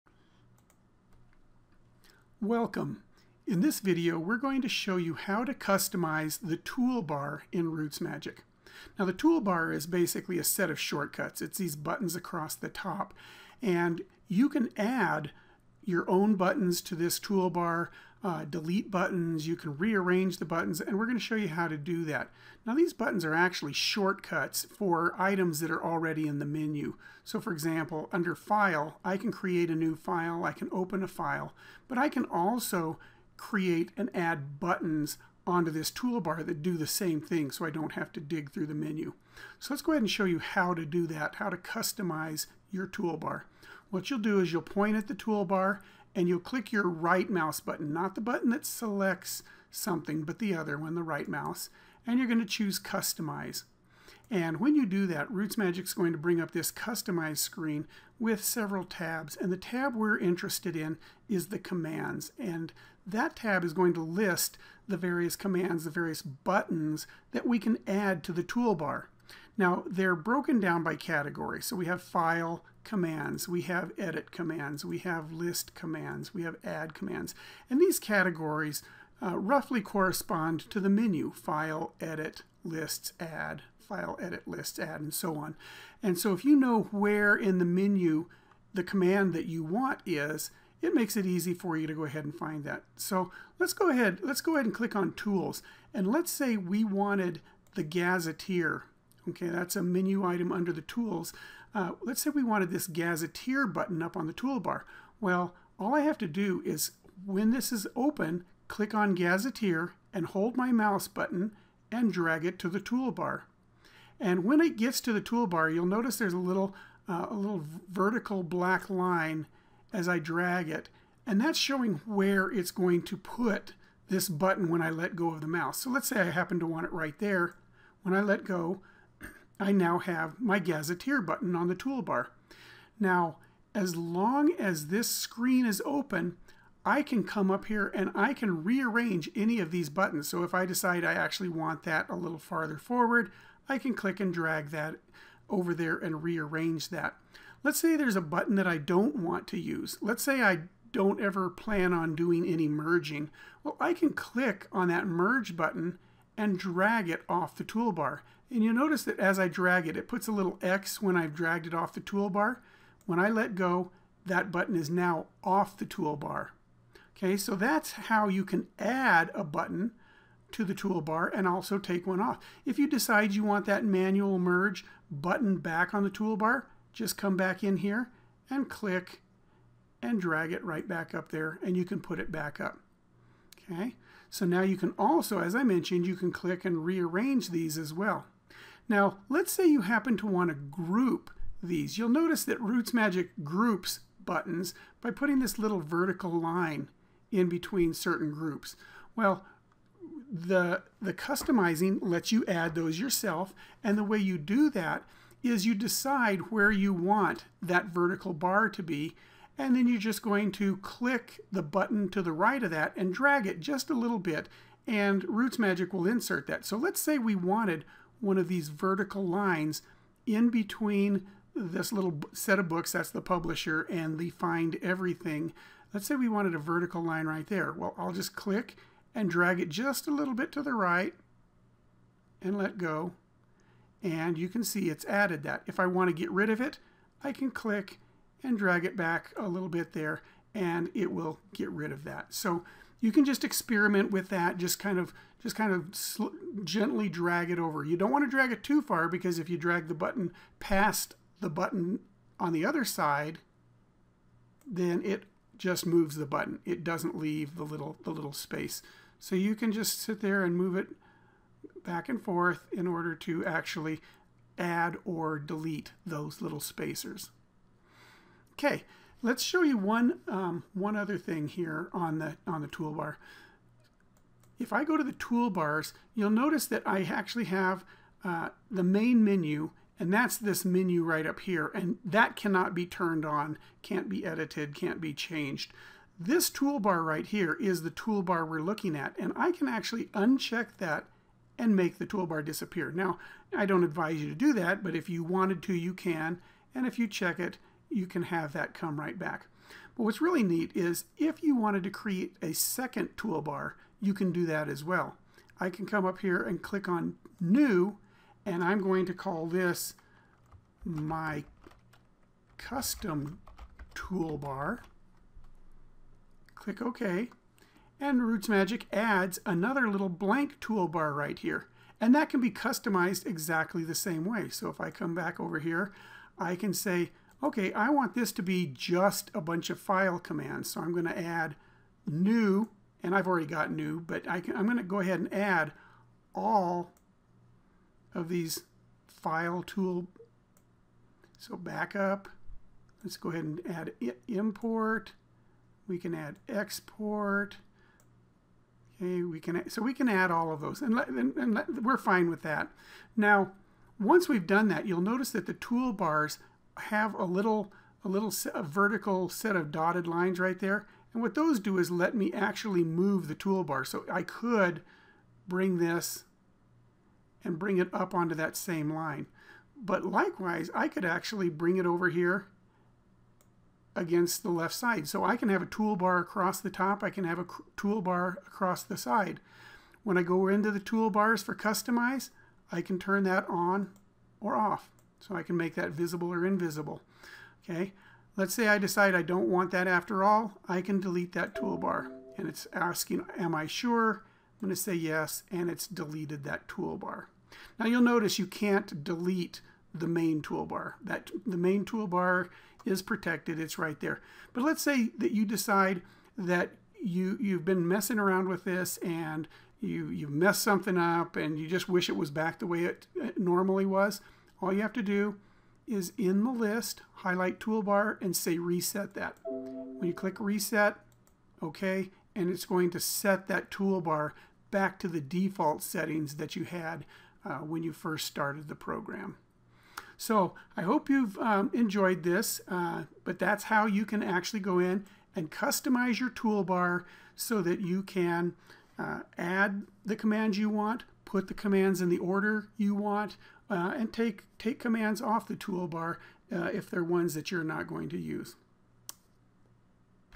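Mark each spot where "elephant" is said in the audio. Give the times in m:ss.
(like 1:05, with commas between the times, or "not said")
not said.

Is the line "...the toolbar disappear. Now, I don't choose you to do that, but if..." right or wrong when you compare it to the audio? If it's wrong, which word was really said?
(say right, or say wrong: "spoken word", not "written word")
wrong: "advise", not "choose".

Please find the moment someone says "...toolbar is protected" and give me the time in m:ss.
6:41.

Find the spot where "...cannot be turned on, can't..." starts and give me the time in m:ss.
4:42.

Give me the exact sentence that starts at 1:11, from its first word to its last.
So we have File, commands, we have edit commands, we have list commands, we have add commands.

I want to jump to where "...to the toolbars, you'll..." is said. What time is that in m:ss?
4:34.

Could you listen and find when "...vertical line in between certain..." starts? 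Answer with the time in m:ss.
3:15.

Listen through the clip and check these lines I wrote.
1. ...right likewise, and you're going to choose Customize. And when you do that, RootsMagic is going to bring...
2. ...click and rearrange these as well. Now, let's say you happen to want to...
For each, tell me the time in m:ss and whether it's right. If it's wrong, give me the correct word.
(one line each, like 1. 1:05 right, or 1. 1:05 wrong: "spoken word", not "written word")
1. 0:51 wrong: "mouse", not "likewise"
2. 3:06 right.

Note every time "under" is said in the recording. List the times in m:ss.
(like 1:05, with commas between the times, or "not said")
0:28, 1:40.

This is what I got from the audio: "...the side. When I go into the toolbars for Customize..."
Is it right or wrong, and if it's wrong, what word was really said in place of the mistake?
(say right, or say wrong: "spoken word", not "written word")
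right.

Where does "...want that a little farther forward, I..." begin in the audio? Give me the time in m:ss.
2:21.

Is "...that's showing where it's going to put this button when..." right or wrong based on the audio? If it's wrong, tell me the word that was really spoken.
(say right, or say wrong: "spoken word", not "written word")
right.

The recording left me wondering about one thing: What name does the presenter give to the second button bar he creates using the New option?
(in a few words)
Custom toolbar.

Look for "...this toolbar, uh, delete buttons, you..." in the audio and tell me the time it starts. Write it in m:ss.
0:16.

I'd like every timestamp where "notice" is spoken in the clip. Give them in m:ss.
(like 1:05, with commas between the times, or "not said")
1:55, 2:38, 3:12, 4:36, 5:55, 6:38.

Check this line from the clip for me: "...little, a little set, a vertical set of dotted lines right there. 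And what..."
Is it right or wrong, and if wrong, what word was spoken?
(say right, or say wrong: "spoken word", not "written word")
right.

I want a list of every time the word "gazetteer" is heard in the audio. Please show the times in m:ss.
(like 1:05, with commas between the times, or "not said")
1:37, 1:42, 1:49, 2:10.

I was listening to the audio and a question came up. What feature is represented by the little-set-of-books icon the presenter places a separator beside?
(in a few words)
Publisher.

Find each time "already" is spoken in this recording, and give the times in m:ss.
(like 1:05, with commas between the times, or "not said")
0:25, 5:33.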